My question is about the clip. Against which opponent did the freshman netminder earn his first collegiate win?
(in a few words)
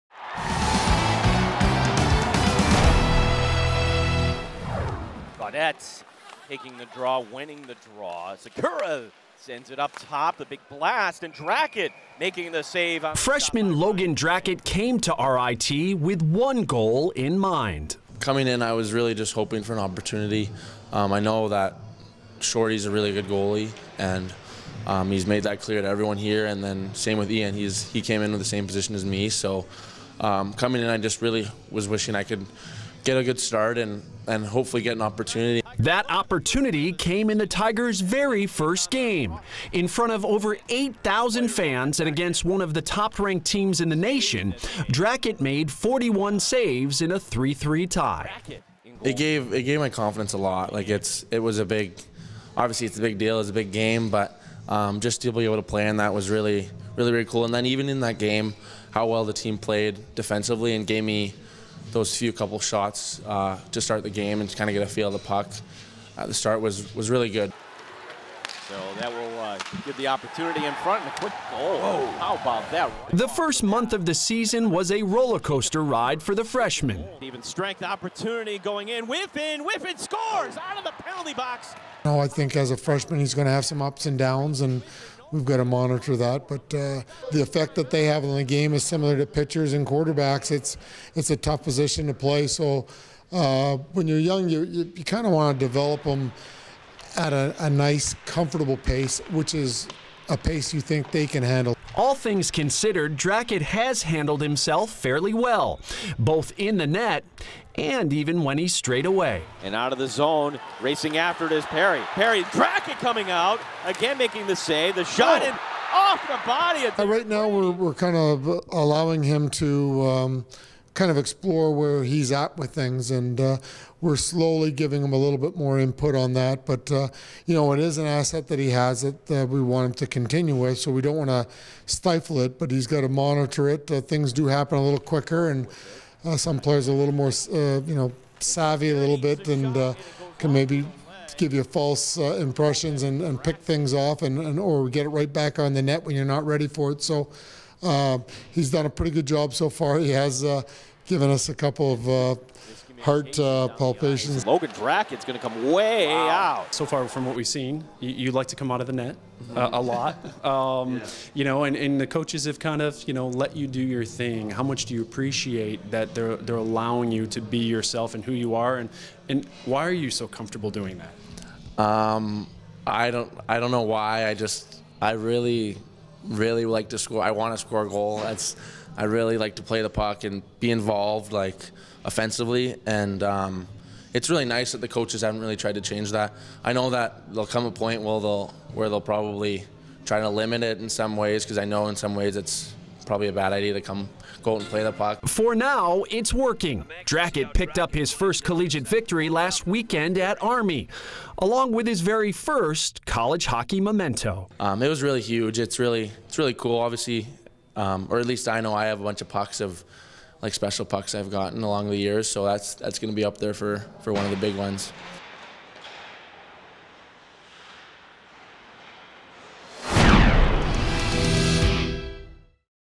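Army.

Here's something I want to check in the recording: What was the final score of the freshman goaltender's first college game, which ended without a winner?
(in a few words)
3-3.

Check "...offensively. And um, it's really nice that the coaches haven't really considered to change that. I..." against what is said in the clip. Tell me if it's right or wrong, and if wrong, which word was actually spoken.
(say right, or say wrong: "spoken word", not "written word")
wrong: "tried", not "considered".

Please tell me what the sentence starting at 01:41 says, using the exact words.
All things considered, Drackett has handled himself fairly well, both in the net and even when he's straight away.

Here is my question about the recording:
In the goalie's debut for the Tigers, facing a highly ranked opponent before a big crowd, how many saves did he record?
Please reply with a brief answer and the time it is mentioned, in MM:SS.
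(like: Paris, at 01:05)
41, at 00:45.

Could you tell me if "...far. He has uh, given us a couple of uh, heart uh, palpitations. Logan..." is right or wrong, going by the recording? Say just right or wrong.
right.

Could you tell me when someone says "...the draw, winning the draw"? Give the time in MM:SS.
00:06.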